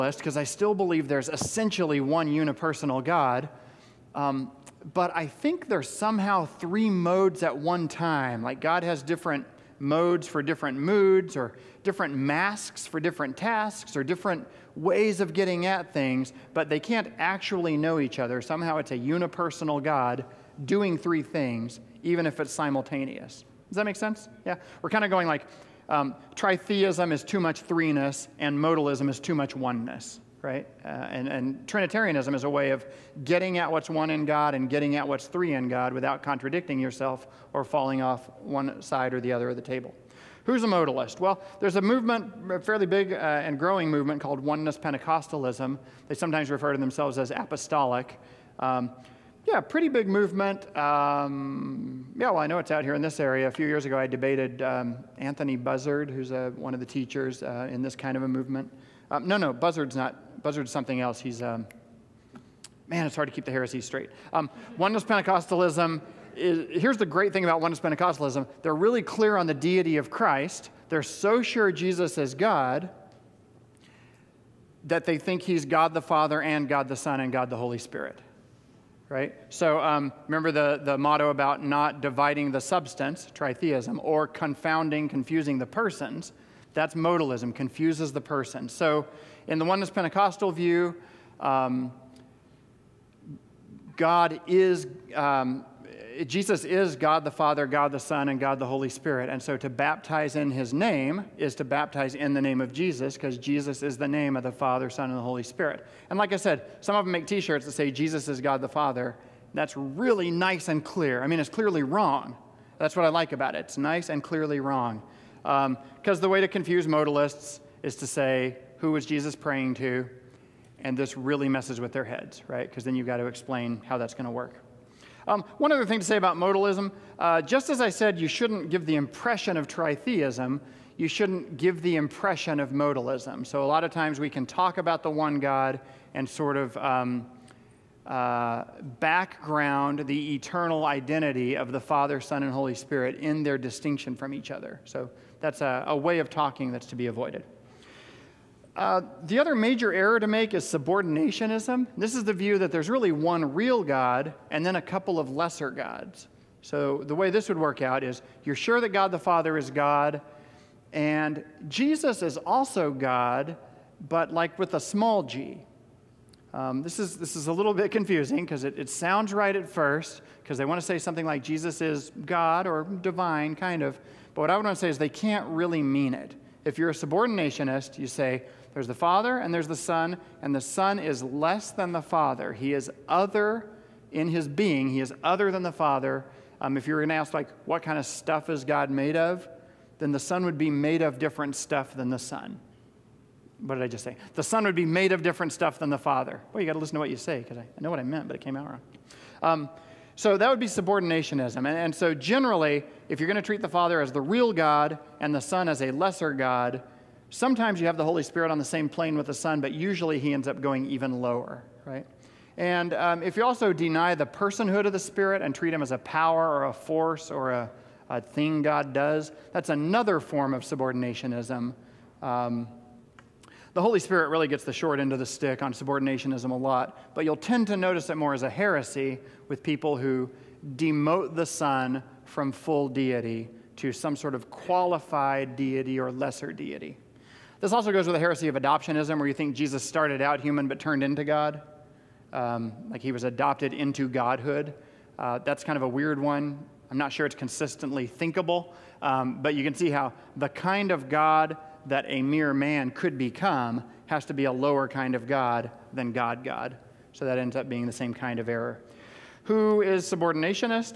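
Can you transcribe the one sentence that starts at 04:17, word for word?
So that ends up being the same kind of error.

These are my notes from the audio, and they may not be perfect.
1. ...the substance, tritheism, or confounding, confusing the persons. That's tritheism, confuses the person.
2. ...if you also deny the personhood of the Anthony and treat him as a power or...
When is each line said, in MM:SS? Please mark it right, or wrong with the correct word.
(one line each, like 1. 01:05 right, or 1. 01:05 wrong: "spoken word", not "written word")
1. 01:22 wrong: "modalism", not "tritheism"
2. 03:33 wrong: "Spirit", not "Anthony".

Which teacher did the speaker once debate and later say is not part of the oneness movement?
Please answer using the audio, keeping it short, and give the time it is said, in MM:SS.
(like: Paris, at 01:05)
Anthony Buzzard, at 00:55.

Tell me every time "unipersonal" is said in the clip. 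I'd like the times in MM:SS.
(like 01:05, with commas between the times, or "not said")
00:02, 00:18.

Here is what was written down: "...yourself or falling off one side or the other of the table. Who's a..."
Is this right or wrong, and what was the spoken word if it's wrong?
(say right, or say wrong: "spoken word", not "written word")
right.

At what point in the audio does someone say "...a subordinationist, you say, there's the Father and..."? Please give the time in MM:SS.
02:56.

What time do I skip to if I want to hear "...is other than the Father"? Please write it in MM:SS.
03:04.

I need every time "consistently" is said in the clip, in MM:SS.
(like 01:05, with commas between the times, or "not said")
04:07.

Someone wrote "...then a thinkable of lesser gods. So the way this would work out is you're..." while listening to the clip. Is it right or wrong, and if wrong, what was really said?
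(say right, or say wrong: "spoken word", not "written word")
wrong: "couple", not "thinkable".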